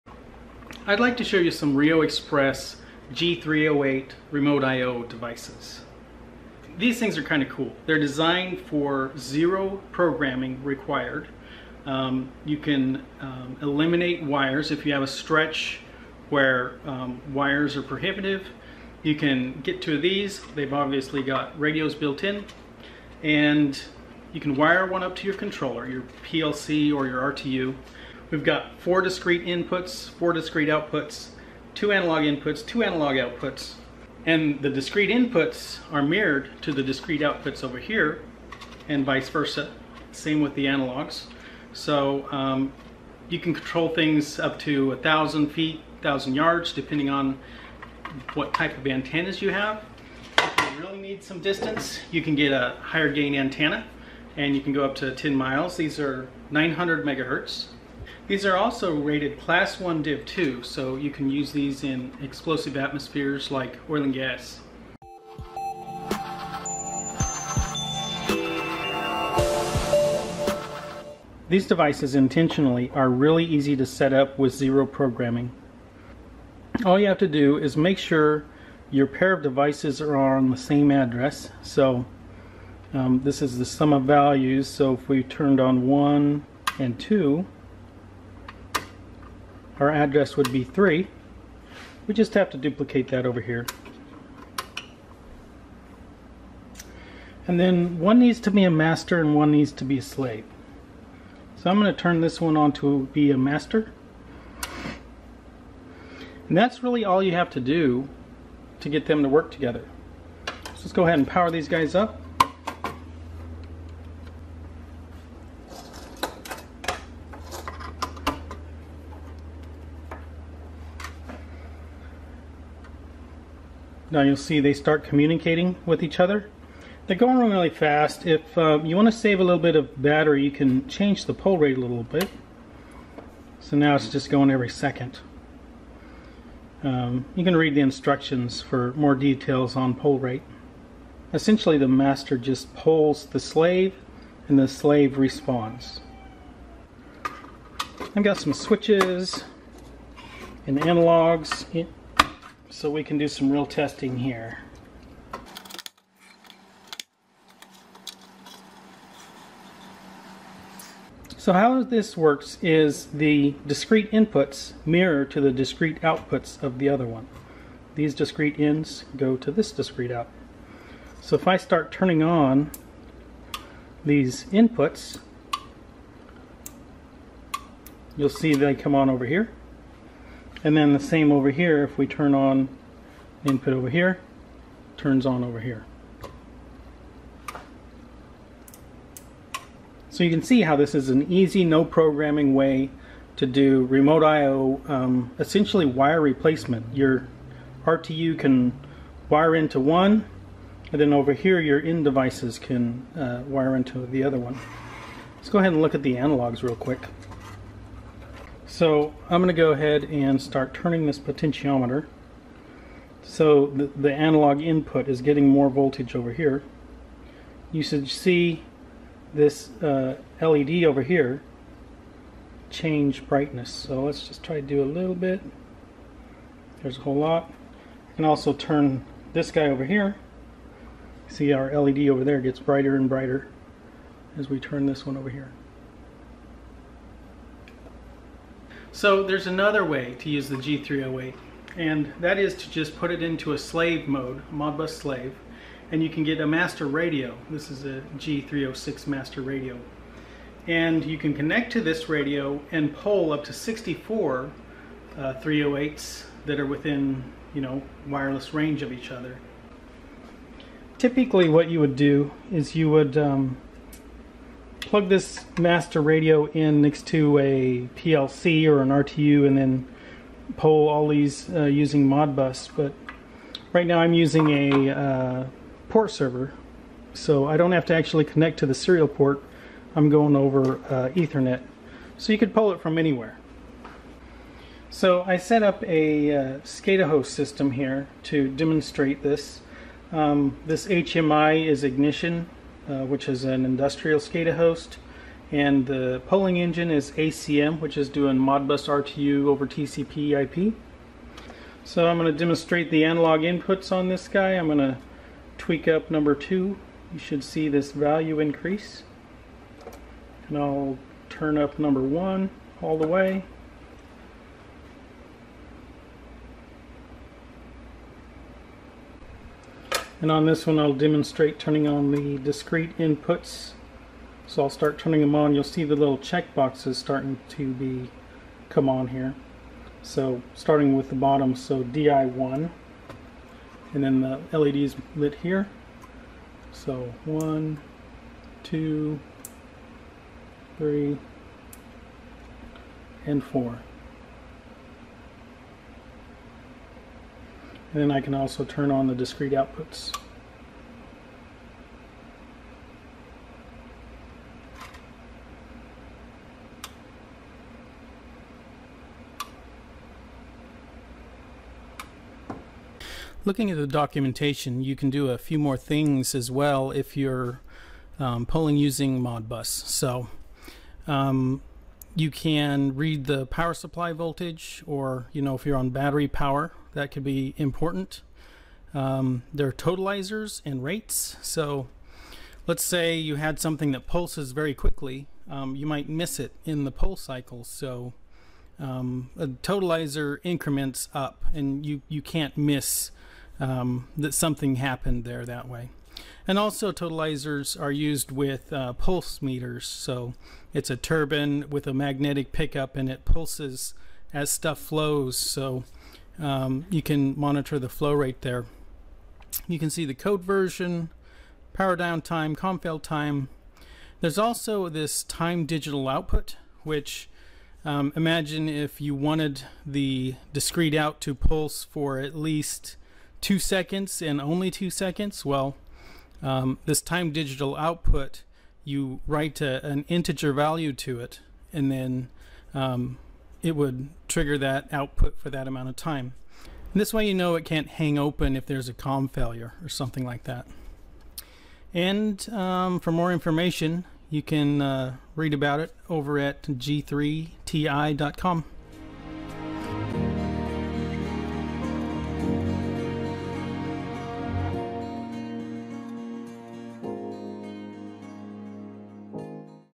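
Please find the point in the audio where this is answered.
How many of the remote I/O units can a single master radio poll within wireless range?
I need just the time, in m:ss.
4:13.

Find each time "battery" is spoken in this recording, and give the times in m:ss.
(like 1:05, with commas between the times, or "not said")
2:10, 6:15.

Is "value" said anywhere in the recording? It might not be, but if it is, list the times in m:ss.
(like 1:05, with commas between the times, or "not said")
1:24, 5:07, 7:10.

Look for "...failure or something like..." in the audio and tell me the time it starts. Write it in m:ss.
7:19.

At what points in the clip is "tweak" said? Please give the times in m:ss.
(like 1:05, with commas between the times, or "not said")
5:05.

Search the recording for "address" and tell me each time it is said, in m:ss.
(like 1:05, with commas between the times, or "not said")
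1:20, 1:29.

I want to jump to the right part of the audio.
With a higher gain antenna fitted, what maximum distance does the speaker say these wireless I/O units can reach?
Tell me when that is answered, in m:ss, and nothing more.
0:55.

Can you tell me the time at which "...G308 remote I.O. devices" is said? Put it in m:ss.
0:03.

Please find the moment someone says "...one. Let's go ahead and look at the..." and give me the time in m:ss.
3:24.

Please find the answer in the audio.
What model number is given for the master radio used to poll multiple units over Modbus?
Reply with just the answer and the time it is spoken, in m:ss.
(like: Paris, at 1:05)
G306, at 4:08.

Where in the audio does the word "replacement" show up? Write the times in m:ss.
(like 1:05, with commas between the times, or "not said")
3:16.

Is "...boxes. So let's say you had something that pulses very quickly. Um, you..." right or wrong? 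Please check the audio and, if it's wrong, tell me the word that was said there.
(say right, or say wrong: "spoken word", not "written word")
wrong: "rates", not "boxes".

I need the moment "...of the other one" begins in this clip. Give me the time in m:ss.
2:46.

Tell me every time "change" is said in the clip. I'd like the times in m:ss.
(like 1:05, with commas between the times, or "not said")
2:10, 3:42.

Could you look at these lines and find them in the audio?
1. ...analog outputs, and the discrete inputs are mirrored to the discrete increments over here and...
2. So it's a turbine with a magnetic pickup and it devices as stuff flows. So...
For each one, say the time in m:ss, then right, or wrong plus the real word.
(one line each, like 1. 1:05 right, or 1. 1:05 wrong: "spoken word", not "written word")
1. 0:32 wrong: "outputs", not "increments"
2. 6:39 wrong: "pulses", not "devices".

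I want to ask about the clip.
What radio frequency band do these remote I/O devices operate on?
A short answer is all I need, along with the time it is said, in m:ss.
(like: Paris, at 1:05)
900 megahertz, at 0:56.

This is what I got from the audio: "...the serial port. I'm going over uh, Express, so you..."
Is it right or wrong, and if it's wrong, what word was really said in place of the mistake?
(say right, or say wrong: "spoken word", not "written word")
wrong: "Ethernet", not "Express".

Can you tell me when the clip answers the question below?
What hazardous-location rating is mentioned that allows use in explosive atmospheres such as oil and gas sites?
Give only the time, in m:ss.
0:59.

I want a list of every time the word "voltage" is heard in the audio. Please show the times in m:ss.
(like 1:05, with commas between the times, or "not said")
3:35, 6:14.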